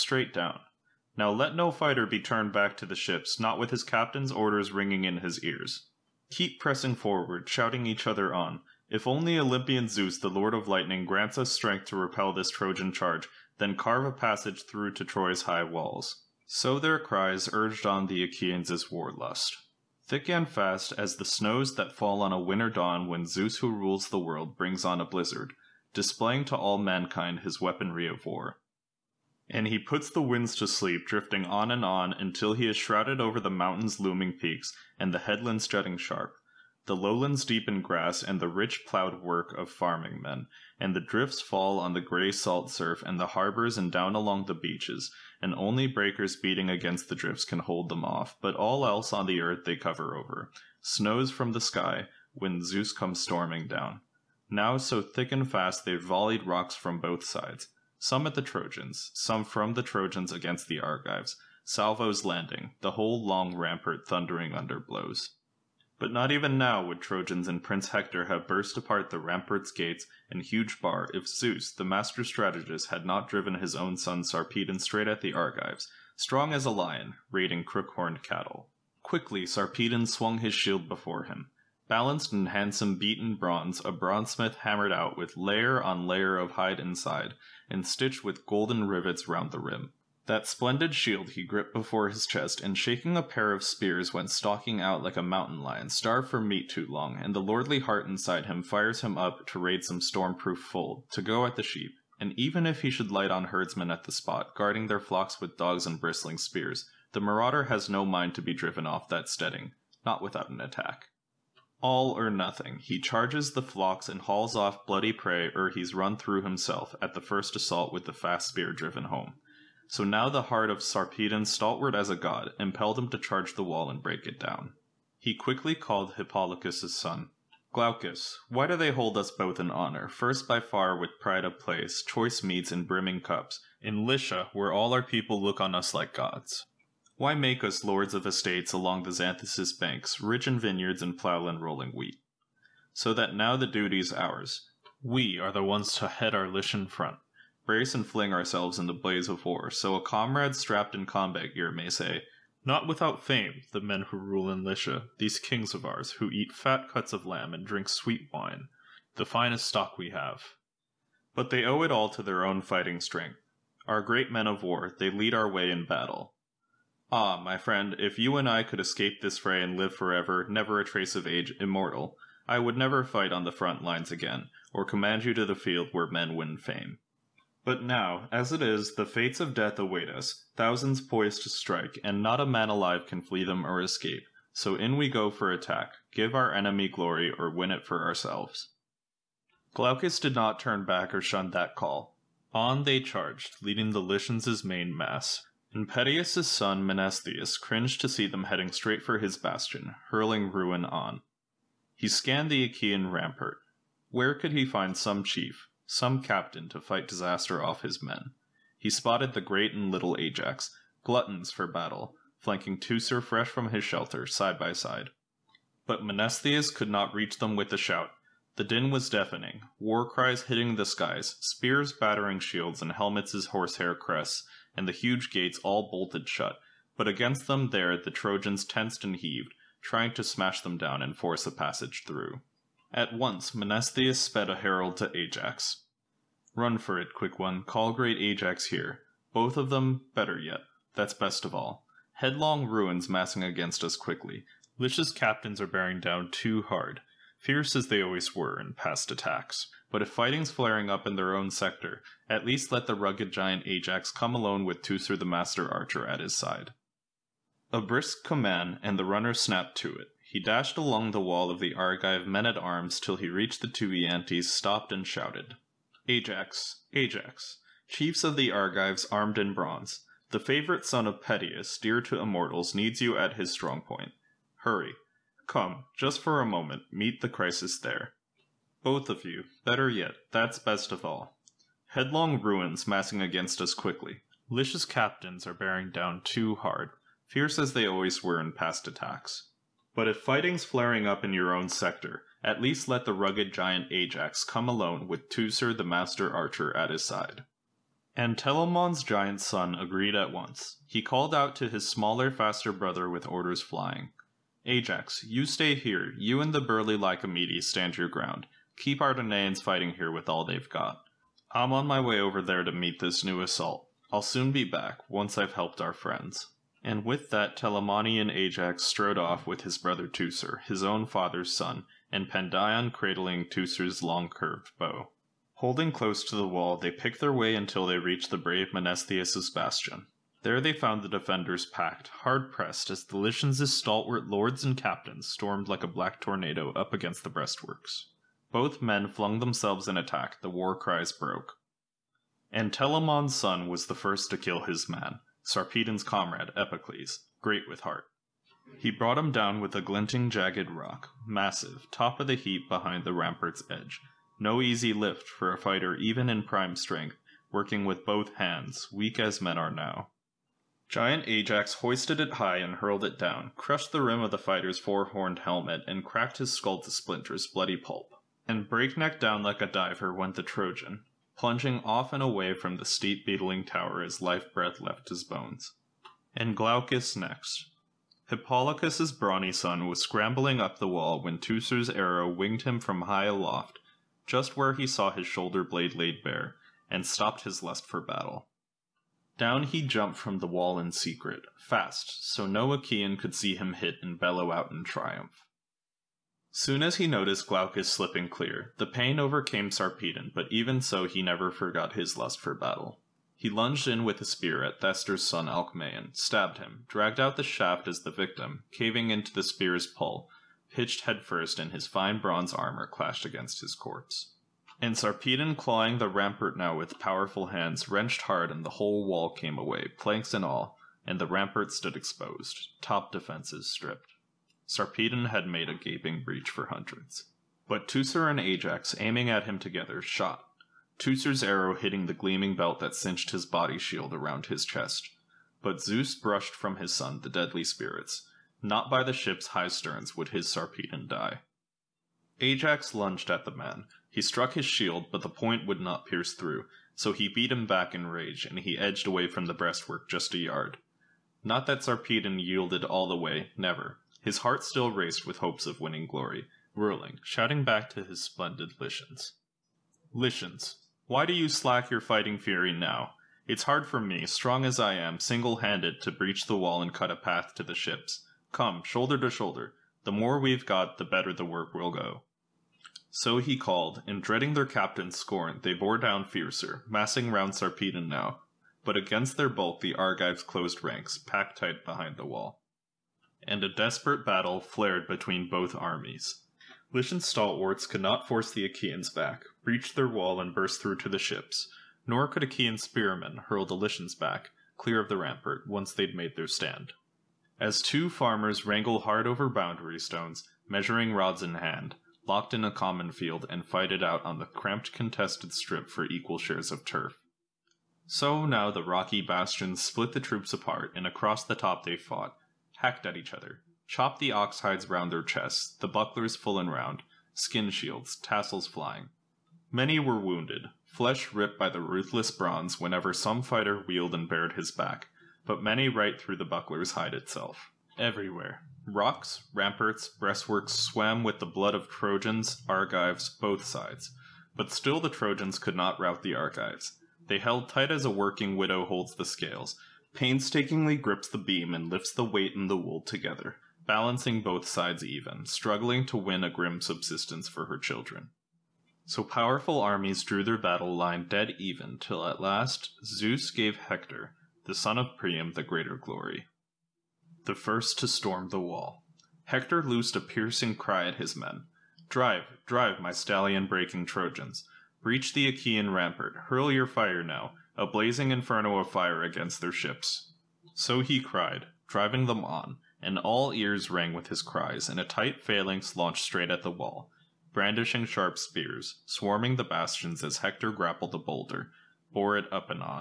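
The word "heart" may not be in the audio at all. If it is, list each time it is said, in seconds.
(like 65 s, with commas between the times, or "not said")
97 s, 120 s, 347 s, 454 s.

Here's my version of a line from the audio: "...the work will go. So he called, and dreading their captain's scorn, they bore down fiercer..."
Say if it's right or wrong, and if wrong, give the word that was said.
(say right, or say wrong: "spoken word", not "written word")
right.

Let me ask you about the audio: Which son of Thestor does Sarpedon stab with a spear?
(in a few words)
Alcmaeon.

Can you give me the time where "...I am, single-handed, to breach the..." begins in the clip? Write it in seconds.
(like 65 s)
464 s.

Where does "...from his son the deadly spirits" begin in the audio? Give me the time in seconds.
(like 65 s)
436 s.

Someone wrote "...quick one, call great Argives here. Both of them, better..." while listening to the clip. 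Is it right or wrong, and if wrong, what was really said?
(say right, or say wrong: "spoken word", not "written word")
wrong: "Ajax", not "Argives".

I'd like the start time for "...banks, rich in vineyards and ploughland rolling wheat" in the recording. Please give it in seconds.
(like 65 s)
139 s.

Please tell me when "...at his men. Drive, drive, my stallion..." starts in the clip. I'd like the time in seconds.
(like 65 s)
561 s.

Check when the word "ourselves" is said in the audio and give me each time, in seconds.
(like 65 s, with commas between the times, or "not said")
148 s, 188 s.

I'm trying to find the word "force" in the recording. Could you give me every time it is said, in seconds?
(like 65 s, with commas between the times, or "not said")
231 s, 488 s.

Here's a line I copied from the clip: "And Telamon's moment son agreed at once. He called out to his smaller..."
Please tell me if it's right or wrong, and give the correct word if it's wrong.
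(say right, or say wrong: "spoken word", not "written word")
wrong: "giant", not "moment".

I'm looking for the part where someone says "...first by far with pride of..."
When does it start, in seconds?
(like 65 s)
130 s.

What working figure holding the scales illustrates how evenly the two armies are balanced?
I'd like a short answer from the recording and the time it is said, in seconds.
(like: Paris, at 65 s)
A working widow, at 538 s.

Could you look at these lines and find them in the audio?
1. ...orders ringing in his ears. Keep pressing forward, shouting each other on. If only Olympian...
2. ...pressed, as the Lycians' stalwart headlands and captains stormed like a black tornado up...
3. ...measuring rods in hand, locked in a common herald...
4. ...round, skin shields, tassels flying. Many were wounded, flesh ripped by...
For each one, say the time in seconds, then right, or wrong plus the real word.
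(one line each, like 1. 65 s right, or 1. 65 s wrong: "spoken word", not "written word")
1. 4 s right
2. 332 s wrong: "lords", not "headlands"
3. 500 s wrong: "field", not "herald"
4. 516 s right.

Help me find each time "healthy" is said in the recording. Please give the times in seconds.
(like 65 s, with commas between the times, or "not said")
not said.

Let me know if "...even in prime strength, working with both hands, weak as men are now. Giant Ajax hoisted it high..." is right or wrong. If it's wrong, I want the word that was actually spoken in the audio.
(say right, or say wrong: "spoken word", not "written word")
right.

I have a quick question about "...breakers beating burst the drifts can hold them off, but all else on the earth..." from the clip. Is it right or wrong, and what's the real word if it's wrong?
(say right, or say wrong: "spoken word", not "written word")
wrong: "against", not "burst".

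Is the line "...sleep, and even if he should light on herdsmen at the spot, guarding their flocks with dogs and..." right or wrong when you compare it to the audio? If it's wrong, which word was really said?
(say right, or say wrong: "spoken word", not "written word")
wrong: "sheep", not "sleep".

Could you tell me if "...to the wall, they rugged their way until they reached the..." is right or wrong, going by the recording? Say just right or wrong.
wrong.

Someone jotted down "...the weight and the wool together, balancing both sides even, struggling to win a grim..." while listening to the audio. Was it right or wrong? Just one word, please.
right.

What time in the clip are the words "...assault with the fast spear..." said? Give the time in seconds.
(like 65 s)
117 s.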